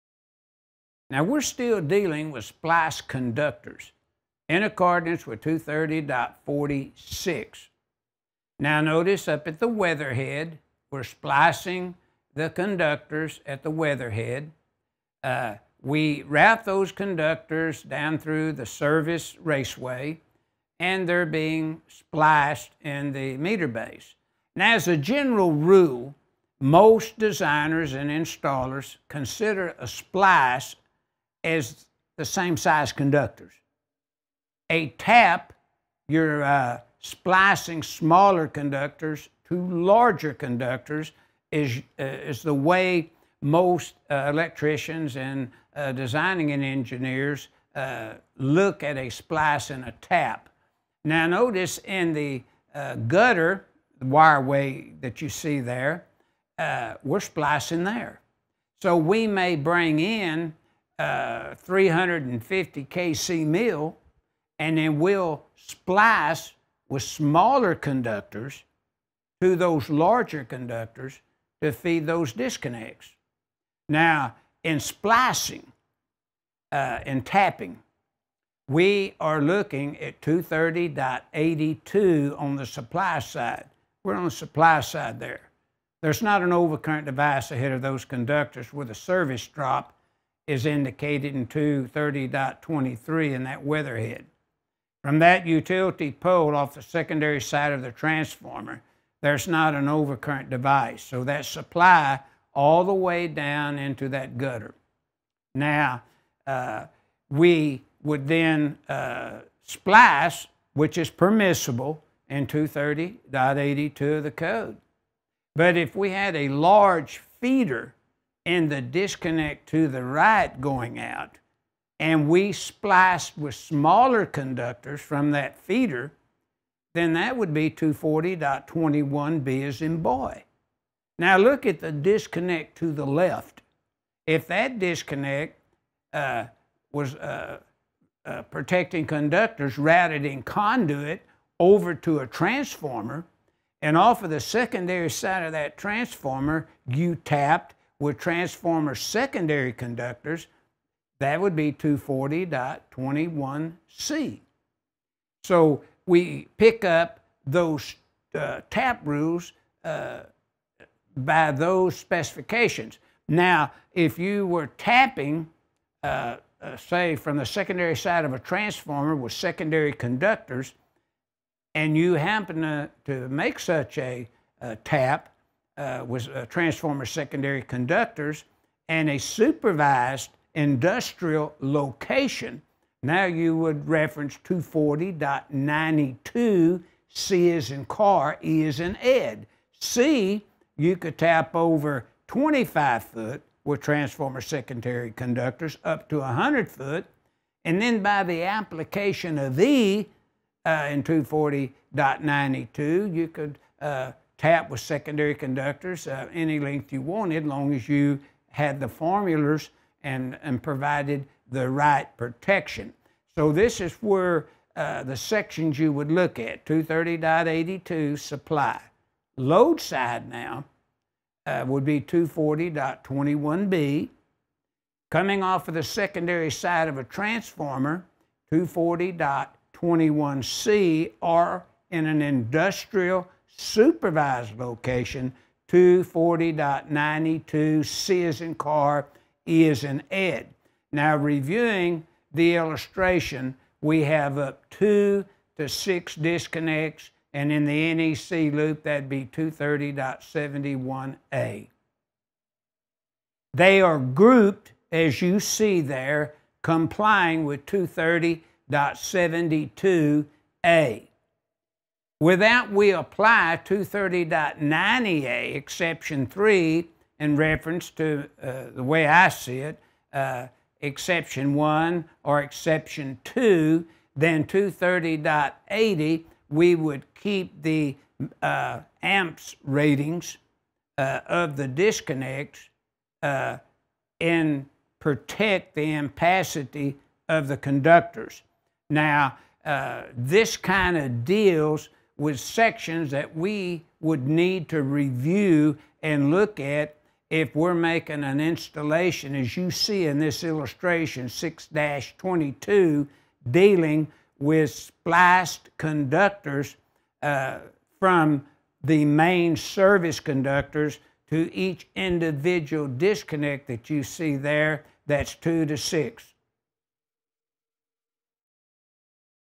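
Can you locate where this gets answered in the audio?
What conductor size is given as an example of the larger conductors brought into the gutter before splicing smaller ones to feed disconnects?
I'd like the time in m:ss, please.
1:01.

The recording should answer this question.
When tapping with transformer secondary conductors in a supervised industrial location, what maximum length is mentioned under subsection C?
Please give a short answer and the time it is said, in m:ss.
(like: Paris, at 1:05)
100 foot, at 3:16.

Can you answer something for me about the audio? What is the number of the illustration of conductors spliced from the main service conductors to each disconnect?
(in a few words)
6-22.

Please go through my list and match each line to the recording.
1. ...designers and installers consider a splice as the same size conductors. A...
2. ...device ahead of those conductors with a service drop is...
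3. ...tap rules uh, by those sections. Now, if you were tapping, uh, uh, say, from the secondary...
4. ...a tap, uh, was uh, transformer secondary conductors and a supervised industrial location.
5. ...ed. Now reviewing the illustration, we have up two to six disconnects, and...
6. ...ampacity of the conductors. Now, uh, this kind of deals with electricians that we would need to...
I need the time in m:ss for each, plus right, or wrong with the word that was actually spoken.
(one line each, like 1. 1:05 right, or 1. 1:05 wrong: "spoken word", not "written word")
1. 0:27 right
2. 1:27 right
3. 2:38 wrong: "specifications", not "sections"
4. 2:54 right
5. 4:00 right
6. 4:45 wrong: "sections", not "electricians".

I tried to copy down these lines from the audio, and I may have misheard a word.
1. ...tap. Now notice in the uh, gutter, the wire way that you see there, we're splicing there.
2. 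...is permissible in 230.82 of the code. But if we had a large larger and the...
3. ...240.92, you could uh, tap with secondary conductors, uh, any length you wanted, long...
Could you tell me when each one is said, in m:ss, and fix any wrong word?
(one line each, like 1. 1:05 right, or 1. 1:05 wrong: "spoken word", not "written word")
1. 0:49 right
2. 1:50 wrong: "feeder", not "larger"
3. 3:21 right.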